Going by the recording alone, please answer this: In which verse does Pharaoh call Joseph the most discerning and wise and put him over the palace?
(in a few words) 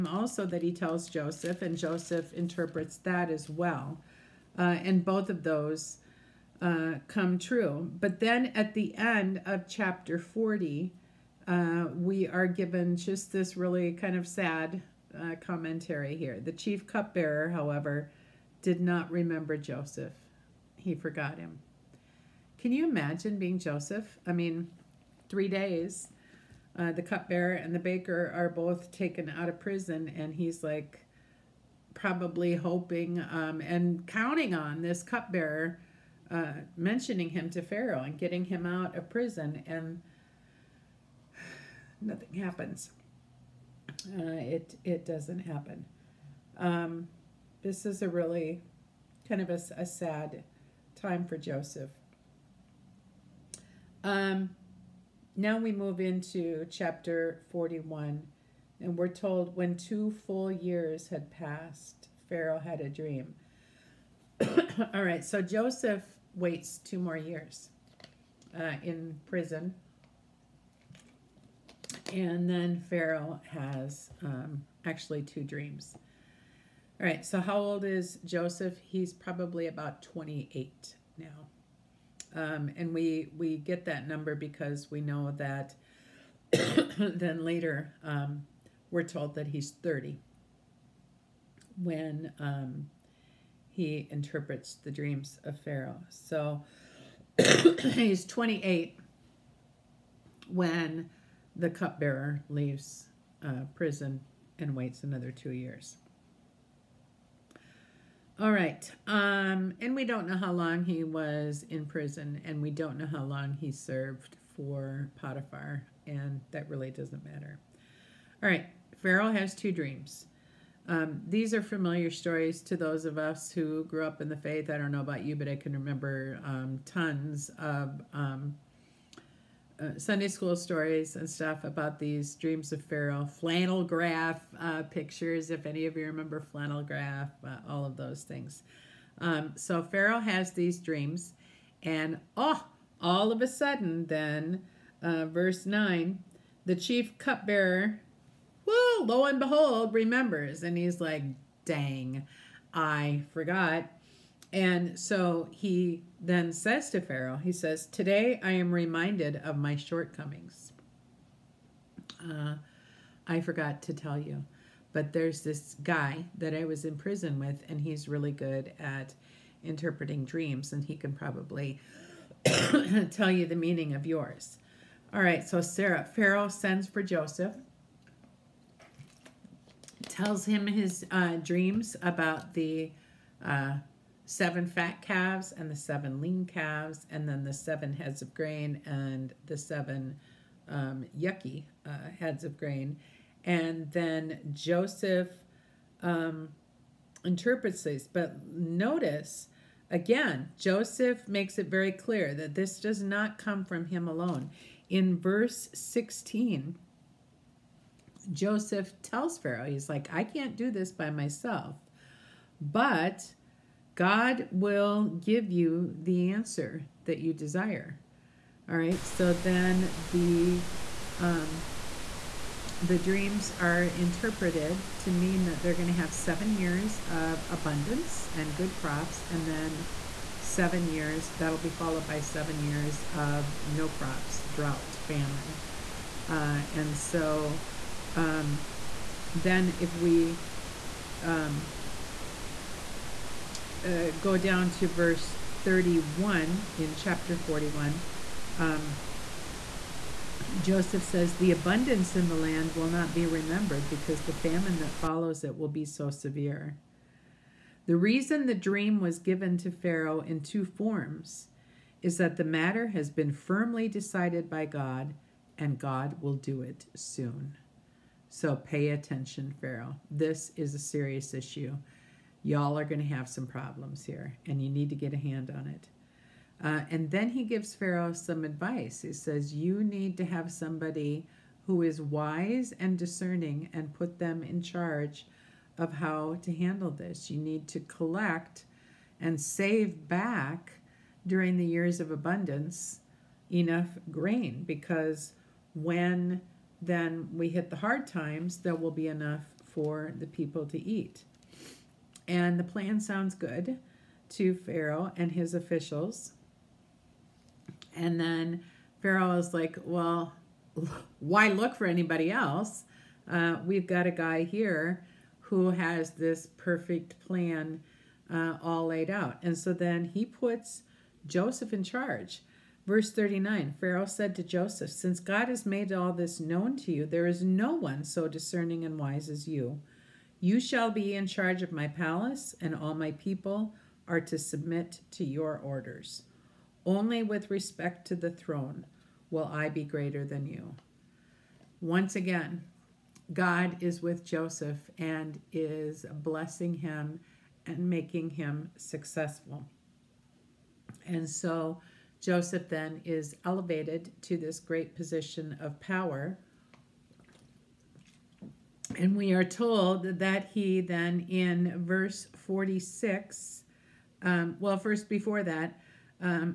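Verse 39.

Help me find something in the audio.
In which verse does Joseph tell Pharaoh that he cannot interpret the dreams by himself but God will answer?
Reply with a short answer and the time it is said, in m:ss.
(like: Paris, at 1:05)
Verse 16, at 3:25.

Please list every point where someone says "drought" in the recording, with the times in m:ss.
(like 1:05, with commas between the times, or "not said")
3:54.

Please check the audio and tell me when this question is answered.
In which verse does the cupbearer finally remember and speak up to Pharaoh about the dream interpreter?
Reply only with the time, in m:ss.
2:25.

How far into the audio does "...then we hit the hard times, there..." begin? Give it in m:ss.
4:56.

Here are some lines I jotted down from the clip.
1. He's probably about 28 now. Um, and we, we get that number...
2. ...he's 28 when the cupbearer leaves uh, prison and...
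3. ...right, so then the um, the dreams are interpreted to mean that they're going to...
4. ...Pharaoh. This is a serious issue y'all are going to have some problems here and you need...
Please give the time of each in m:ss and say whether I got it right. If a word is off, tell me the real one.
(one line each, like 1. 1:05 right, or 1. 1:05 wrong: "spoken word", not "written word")
1. 1:18 right
2. 1:37 right
3. 3:38 right
4. 4:29 right.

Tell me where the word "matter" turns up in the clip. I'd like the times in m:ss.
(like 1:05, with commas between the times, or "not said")
1:57, 4:22.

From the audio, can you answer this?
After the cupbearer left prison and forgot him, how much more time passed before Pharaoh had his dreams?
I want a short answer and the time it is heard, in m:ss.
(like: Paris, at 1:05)
2 full years, at 0:59.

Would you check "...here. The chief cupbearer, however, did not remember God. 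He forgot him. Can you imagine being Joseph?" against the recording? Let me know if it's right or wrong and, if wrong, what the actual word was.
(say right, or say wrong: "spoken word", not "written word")
wrong: "Joseph", not "God".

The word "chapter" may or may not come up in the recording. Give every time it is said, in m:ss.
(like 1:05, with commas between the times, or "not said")
0:09, 0:56, 4:06.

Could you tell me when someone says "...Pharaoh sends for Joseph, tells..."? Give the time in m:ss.
2:56.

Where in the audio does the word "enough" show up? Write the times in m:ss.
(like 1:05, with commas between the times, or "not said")
4:53, 4:59.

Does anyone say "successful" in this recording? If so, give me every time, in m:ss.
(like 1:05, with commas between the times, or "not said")
5:48.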